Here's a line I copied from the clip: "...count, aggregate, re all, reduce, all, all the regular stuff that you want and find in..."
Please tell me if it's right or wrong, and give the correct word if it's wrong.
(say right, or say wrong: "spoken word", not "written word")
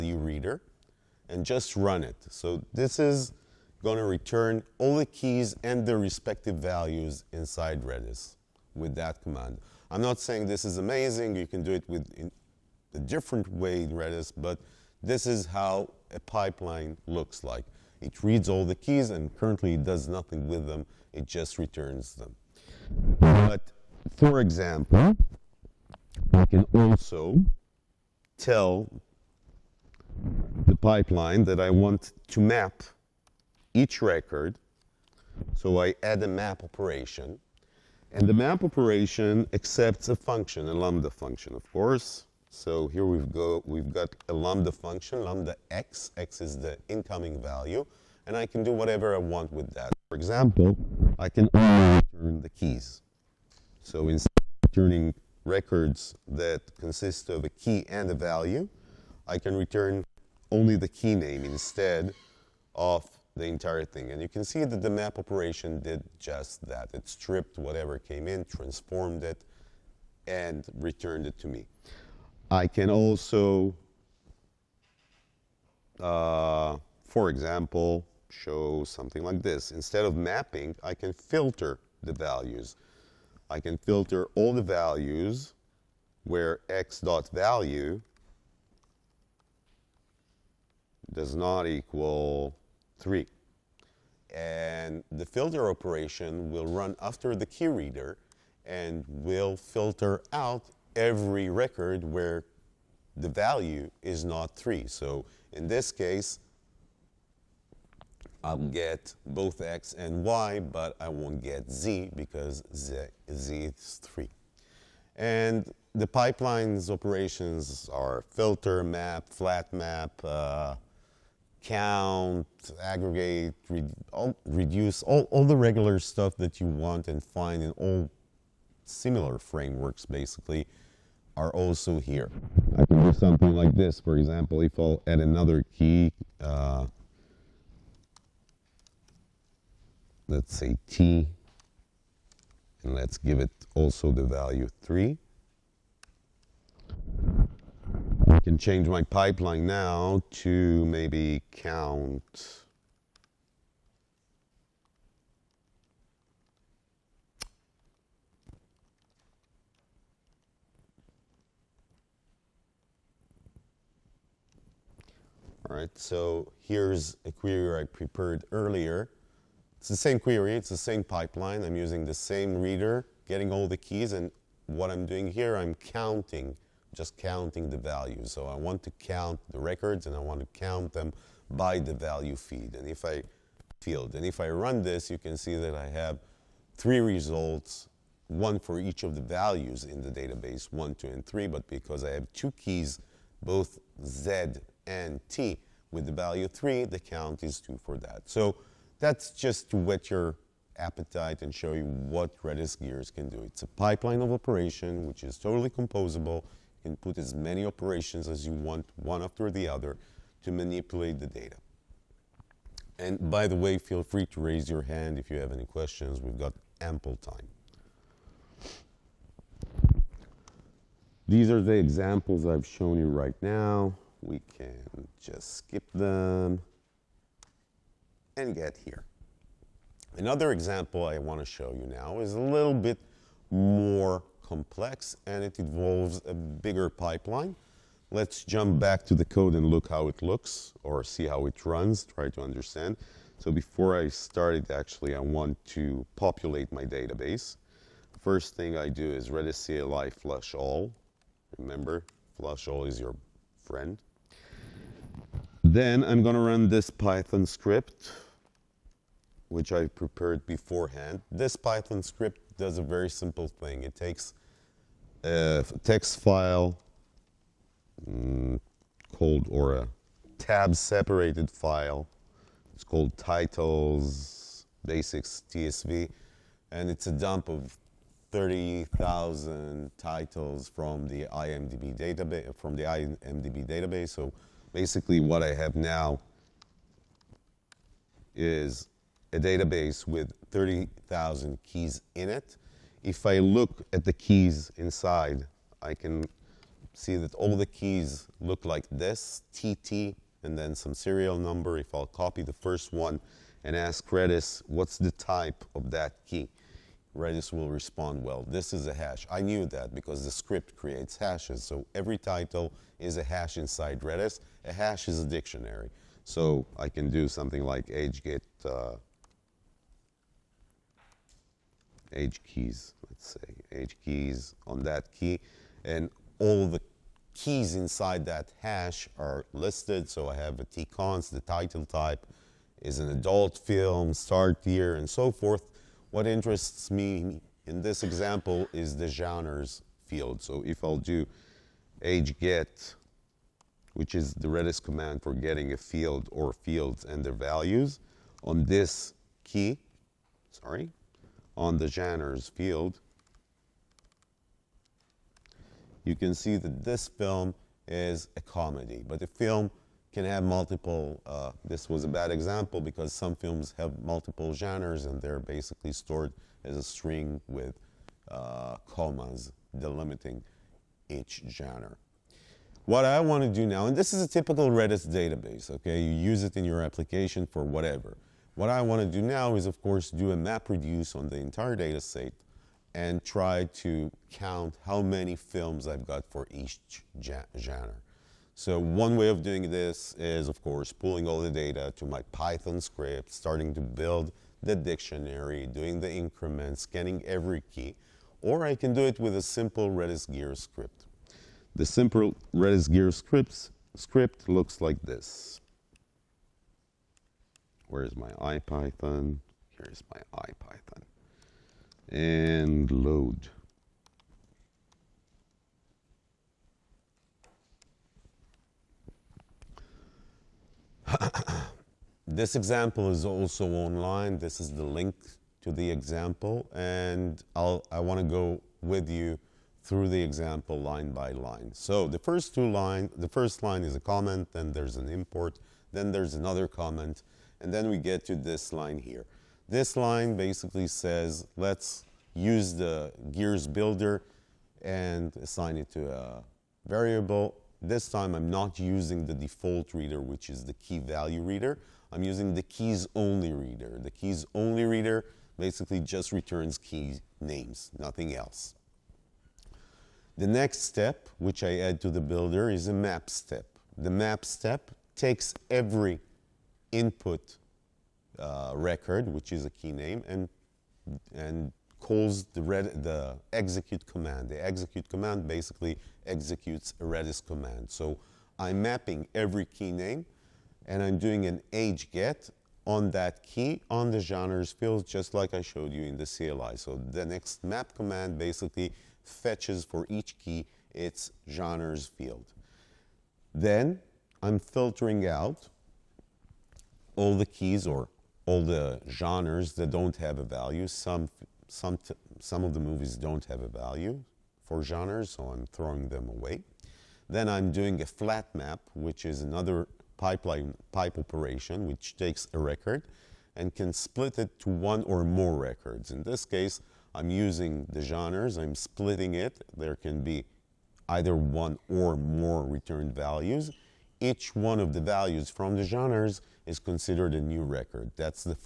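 right.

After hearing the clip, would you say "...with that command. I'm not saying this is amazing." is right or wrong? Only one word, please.
right.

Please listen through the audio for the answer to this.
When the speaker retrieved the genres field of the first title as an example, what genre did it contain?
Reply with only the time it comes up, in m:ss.
5:58.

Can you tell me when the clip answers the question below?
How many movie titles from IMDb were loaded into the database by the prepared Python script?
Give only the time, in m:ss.
4:38.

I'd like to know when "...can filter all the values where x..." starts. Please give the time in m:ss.
1:23.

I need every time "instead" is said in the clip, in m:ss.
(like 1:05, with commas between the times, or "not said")
0:54, 1:01, 1:19.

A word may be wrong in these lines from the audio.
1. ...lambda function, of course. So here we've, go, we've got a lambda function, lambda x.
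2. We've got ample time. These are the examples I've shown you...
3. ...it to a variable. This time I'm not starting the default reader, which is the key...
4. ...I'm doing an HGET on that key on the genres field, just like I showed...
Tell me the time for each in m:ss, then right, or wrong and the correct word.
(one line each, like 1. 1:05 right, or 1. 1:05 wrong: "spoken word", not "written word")
1. 0:40 right
2. 3:36 right
3. 7:25 wrong: "using", not "starting"
4. 8:01 right.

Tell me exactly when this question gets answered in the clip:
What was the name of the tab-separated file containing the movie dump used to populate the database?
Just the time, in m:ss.
4:33.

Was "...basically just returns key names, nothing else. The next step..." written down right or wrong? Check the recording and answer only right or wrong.
right.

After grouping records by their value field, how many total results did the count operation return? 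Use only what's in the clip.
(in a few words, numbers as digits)
3.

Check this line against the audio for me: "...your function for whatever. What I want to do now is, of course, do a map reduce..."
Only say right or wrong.
wrong.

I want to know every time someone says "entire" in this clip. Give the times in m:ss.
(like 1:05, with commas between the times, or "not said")
1:03, 6:21.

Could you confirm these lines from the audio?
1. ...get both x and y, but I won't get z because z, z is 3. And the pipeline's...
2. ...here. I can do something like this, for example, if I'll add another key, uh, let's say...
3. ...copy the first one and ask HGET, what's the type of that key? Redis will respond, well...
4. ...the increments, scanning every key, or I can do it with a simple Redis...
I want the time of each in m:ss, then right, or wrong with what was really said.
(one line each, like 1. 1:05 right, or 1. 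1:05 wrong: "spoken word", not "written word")
1. 1:48 right
2. 2:11 right
3. 5:02 wrong: "Redis", not "HGET"
4. 6:35 right.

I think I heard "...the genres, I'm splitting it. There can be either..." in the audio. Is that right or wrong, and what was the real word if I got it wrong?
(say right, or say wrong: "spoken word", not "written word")
right.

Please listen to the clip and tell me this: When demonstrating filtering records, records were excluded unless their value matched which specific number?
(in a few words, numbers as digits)
3.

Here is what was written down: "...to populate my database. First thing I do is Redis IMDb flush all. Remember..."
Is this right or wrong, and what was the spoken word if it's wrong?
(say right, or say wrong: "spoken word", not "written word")
wrong: "CLI", not "IMDb".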